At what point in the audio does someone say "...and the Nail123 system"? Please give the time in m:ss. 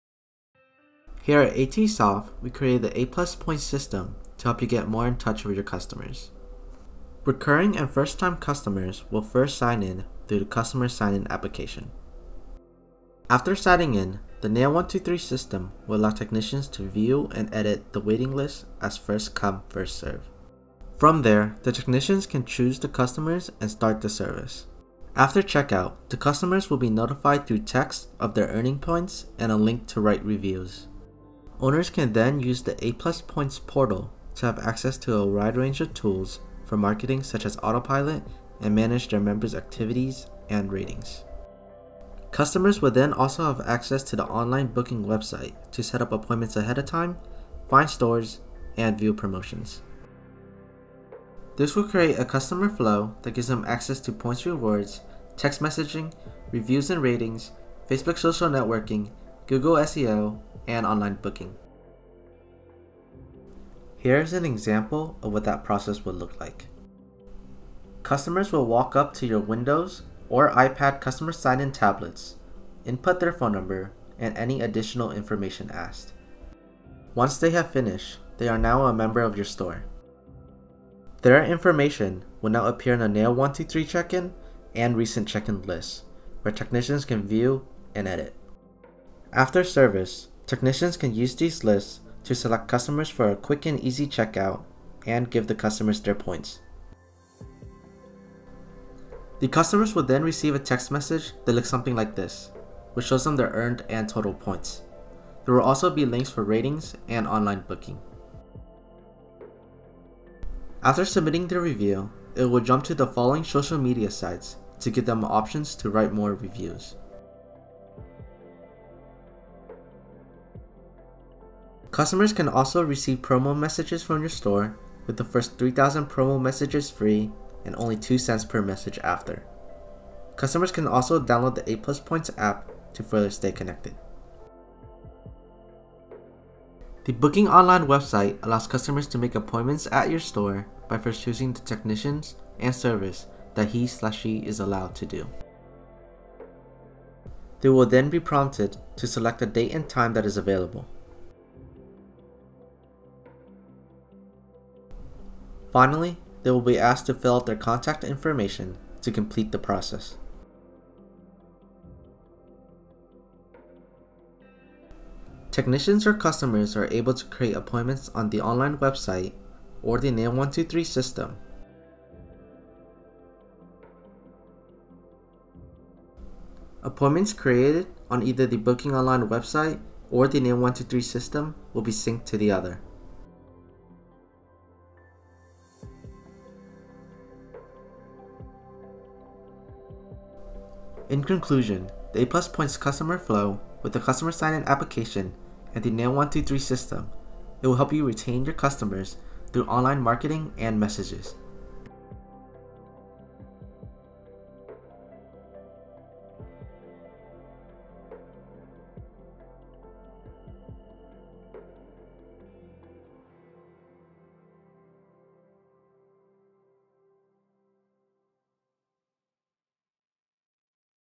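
3:15.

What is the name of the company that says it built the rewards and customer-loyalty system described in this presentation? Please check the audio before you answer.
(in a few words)
ATSoft.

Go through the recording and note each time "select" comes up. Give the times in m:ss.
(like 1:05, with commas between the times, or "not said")
1:32, 2:29.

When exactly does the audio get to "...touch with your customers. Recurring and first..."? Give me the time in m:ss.
0:05.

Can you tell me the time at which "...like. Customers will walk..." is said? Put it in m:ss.
1:06.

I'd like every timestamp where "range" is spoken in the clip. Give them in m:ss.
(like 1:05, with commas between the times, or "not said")
0:35.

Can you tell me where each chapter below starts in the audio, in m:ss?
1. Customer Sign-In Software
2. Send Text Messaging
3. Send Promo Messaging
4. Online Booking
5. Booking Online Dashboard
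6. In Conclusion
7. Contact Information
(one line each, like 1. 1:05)
1. 1:03
2. 1:36
3. 2:00
4. 2:10
5. 2:41
6. 3:03
7. 3:28.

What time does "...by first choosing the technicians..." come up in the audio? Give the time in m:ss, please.
2:20.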